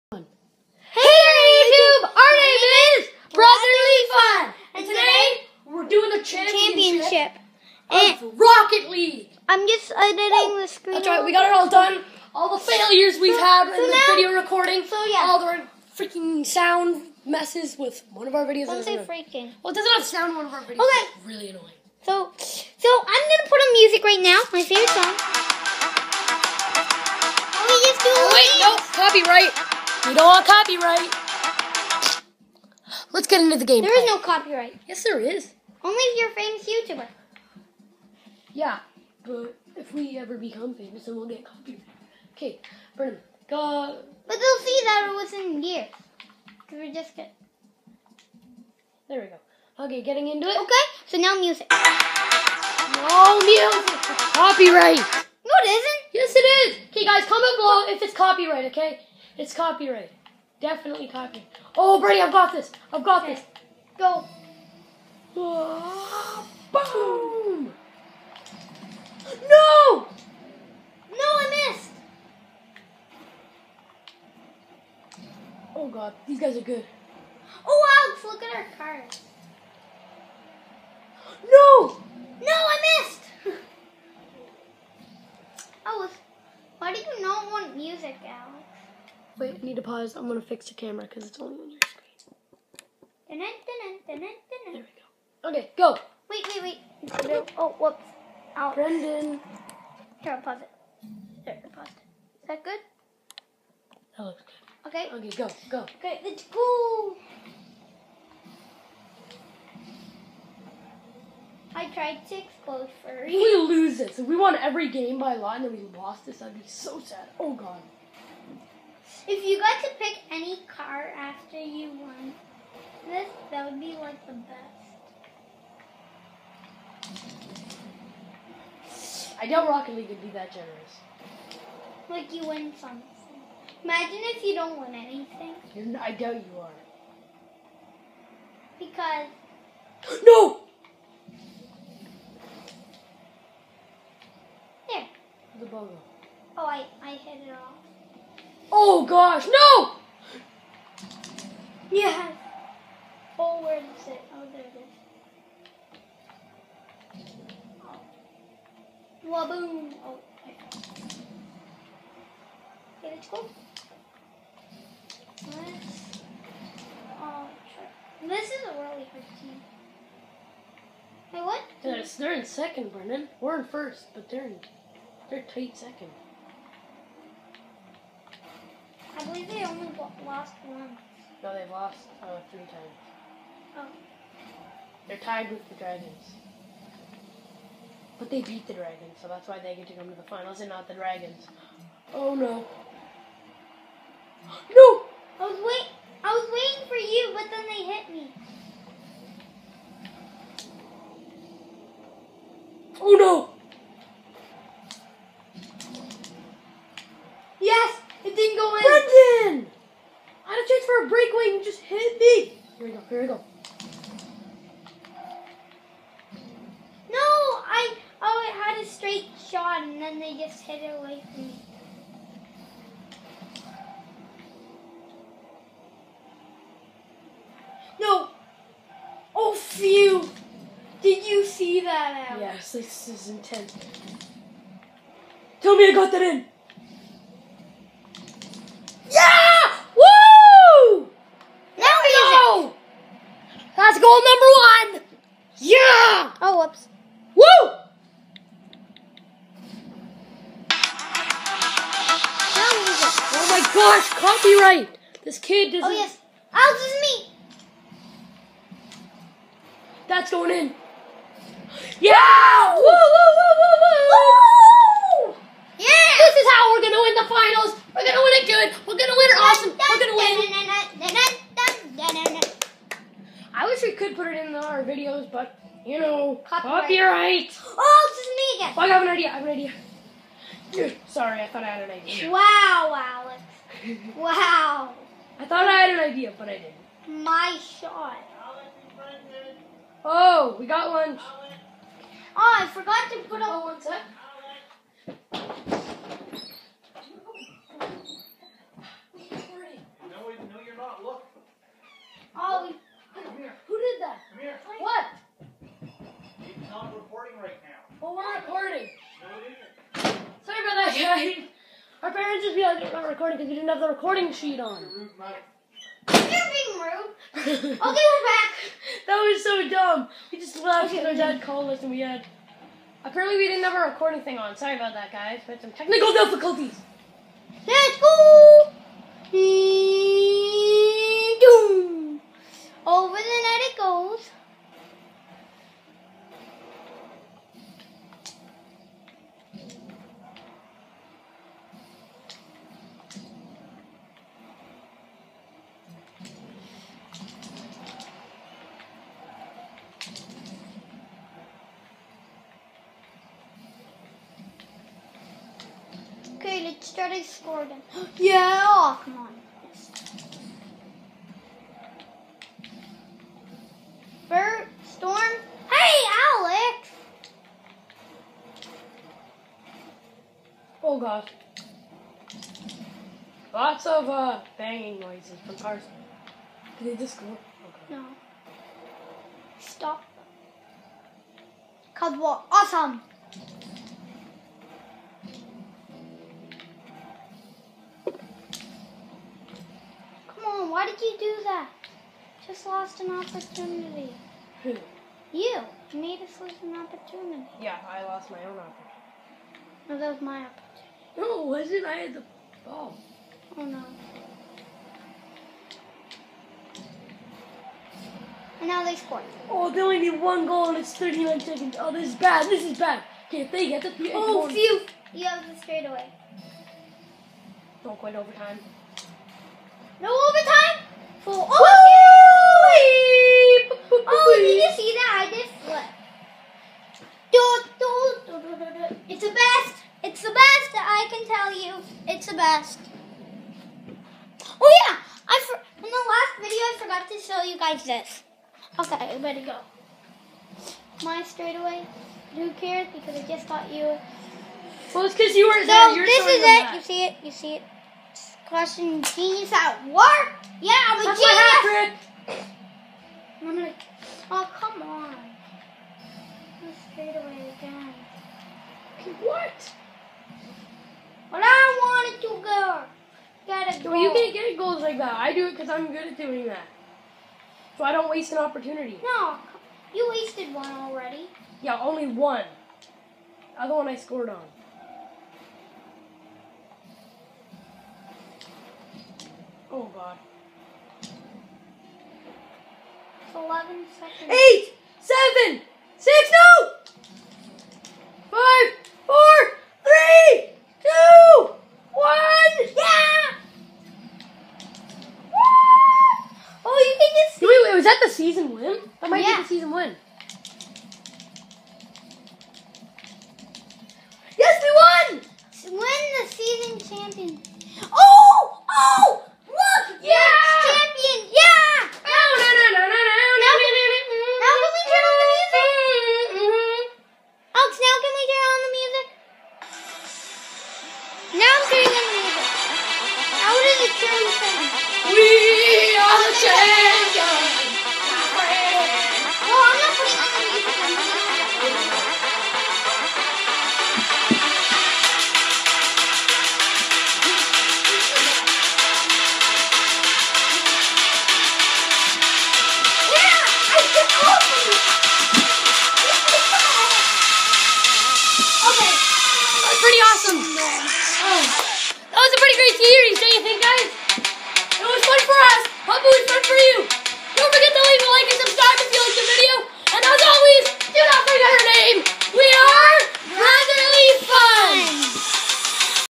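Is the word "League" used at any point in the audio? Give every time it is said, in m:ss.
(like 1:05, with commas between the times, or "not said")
0:08, 2:09.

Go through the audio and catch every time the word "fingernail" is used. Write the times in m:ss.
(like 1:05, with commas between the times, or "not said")
not said.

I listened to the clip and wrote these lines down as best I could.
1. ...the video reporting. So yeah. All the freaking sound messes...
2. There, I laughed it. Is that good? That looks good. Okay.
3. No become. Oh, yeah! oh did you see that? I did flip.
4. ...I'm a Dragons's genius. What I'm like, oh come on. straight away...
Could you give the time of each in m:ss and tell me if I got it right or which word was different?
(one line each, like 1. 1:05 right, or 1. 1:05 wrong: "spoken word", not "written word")
1. 0:13 wrong: "recording", not "reporting"
2. 1:41 wrong: "paused", not "laughed"
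3. 6:59 wrong: "overtime", not "become"
4. 7:30 wrong: "That", not "Dragons".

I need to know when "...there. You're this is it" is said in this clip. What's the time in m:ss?
7:25.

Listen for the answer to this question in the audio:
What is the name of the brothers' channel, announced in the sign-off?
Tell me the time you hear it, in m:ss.
9:23.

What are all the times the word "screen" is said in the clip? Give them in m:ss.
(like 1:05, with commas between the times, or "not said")
0:10, 1:31.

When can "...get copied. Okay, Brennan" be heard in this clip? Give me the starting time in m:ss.
0:41.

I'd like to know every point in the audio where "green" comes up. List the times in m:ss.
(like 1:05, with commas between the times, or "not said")
5:56.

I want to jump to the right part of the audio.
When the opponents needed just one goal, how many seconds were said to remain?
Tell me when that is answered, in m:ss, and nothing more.
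6:50.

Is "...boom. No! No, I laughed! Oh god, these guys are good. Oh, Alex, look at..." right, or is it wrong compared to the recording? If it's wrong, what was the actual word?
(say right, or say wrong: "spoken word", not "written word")
wrong: "missed", not "laughed".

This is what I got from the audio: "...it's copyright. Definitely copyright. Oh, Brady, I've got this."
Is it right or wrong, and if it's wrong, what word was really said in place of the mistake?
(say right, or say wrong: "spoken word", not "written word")
right.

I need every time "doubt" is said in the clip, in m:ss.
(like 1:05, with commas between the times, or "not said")
2:09, 2:16.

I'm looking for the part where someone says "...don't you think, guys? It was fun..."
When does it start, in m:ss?
9:13.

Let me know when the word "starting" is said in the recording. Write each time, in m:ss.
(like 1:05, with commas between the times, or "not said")
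5:56.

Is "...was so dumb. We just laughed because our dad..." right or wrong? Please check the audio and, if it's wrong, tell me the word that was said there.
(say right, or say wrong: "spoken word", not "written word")
right.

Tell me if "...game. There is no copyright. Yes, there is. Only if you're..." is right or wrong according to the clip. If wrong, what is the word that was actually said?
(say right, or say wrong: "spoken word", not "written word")
right.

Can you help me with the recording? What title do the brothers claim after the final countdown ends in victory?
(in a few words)
Season champion.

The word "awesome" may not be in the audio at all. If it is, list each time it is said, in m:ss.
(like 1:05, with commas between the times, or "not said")
4:29, 6:22, 9:10.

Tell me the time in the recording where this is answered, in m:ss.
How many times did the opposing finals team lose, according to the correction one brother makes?
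3:02.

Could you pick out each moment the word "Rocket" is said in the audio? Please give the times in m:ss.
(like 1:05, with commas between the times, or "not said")
0:08, 2:09.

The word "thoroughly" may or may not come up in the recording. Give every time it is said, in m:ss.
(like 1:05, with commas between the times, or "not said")
not said.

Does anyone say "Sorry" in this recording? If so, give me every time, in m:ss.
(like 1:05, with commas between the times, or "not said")
4:41, 5:24.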